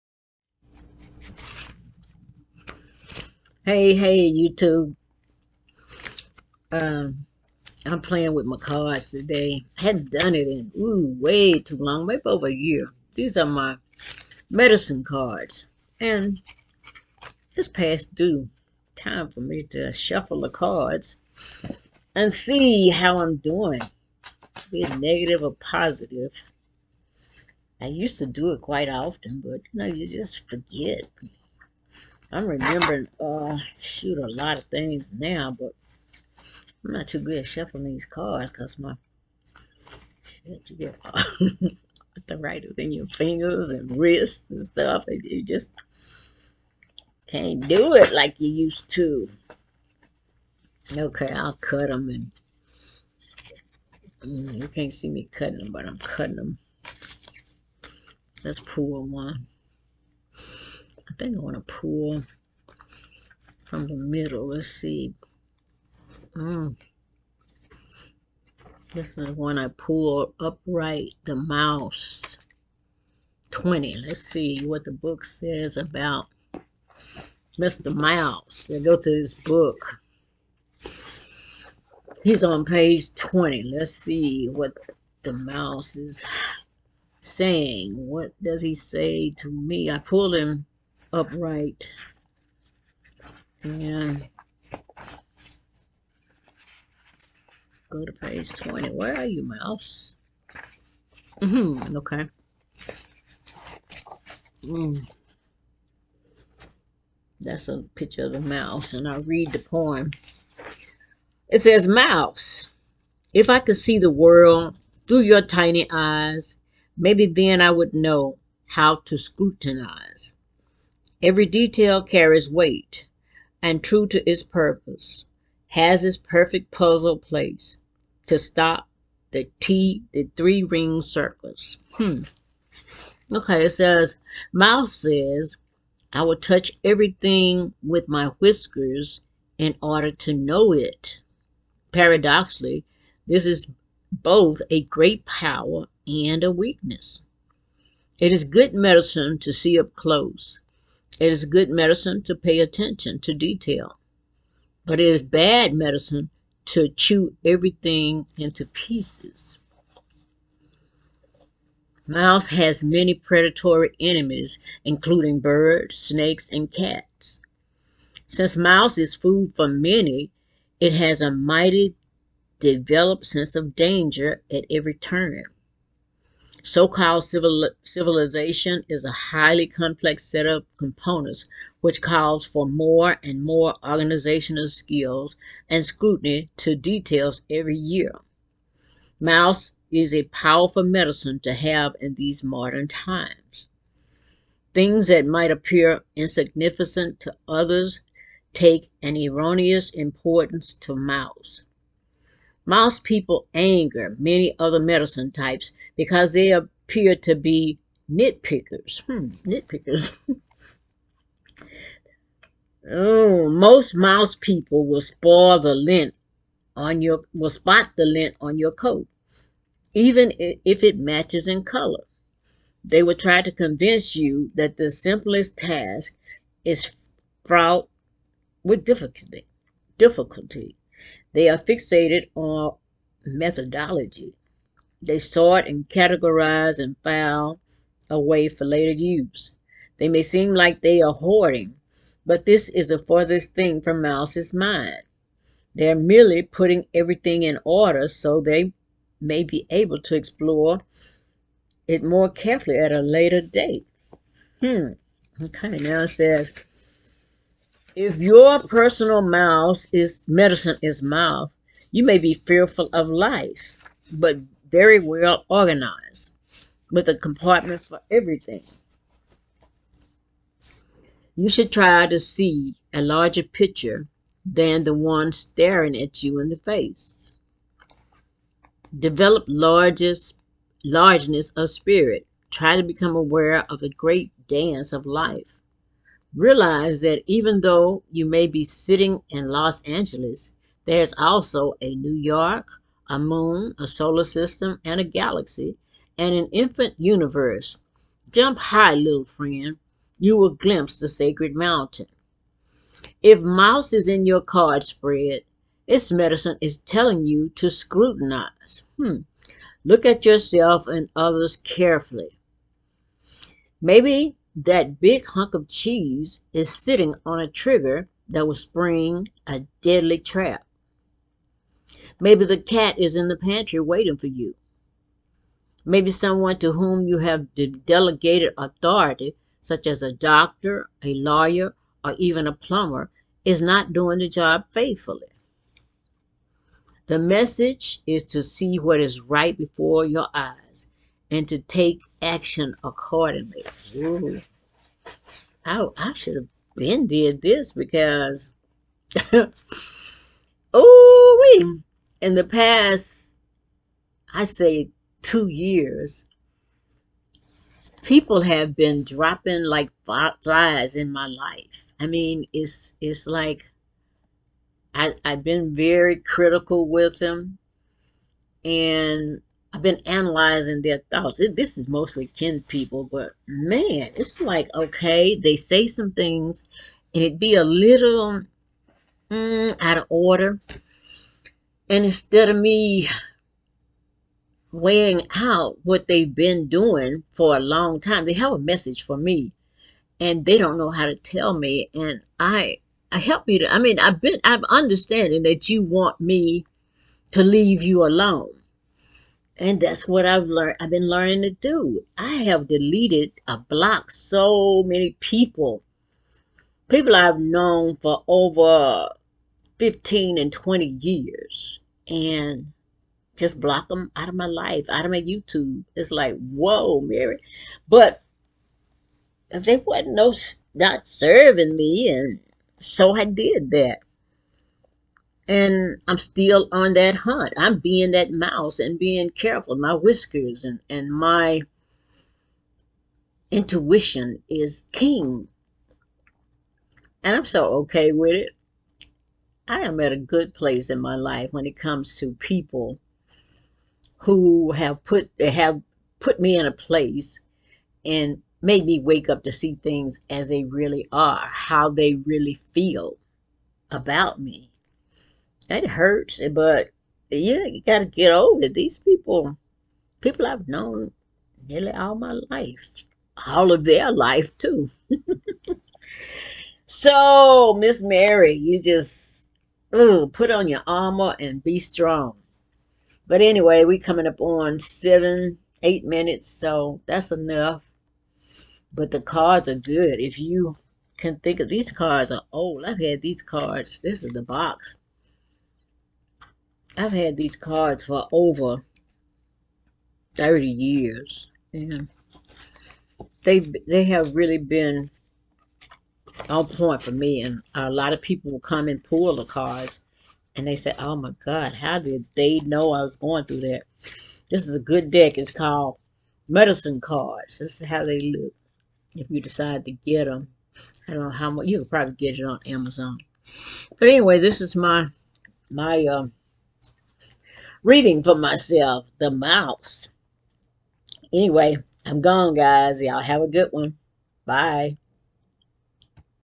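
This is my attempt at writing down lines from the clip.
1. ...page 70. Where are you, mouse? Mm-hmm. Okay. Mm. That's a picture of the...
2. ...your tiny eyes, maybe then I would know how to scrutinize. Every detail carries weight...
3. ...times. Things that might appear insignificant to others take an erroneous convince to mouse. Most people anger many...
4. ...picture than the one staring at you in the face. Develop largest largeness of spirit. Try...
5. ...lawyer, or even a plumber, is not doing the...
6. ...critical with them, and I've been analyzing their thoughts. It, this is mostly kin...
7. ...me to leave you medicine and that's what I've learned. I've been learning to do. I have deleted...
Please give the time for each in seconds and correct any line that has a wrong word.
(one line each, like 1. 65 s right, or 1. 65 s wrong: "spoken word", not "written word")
1. 98 s wrong: "20", not "70"
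2. 115 s right
3. 192 s wrong: "importance", not "convince"
4. 273 s right
5. 331 s right
6. 366 s right
7. 396 s wrong: "alone", not "medicine".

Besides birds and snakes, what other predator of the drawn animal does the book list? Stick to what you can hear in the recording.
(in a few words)
Cats.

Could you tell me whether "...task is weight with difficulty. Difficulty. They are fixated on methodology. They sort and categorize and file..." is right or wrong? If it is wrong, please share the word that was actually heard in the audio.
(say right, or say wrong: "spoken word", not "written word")
wrong: "fraught", not "weight".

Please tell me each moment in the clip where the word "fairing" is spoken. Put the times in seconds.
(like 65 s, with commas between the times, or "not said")
not said.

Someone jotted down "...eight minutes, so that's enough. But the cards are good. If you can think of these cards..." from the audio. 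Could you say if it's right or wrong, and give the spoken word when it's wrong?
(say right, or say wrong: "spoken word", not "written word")
right.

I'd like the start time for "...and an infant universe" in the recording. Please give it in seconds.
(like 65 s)
296 s.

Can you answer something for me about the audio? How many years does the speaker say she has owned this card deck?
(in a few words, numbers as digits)
Over 30.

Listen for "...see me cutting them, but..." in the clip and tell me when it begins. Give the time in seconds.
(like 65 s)
54 s.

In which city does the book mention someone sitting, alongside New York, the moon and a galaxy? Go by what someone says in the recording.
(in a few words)
Los Angeles.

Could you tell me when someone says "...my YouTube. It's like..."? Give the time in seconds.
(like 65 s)
415 s.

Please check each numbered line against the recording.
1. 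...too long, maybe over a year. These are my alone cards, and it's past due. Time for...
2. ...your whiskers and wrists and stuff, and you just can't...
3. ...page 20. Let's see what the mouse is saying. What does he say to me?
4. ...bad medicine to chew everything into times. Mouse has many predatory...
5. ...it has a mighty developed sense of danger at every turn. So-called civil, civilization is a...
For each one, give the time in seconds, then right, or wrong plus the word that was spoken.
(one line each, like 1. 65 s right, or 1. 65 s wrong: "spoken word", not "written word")
1. 11 s wrong: "medicine", not "alone"
2. 42 s wrong: "fingers", not "whiskers"
3. 82 s right
4. 155 s wrong: "pieces", not "times"
5. 170 s right.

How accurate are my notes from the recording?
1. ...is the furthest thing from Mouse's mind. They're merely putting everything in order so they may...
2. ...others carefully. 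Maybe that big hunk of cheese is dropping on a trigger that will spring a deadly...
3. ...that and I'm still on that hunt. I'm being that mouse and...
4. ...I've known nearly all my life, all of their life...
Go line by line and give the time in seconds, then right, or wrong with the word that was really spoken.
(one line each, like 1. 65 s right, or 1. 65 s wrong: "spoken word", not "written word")
1. 242 s right
2. 311 s wrong: "sitting", not "dropping"
3. 423 s right
4. 460 s right.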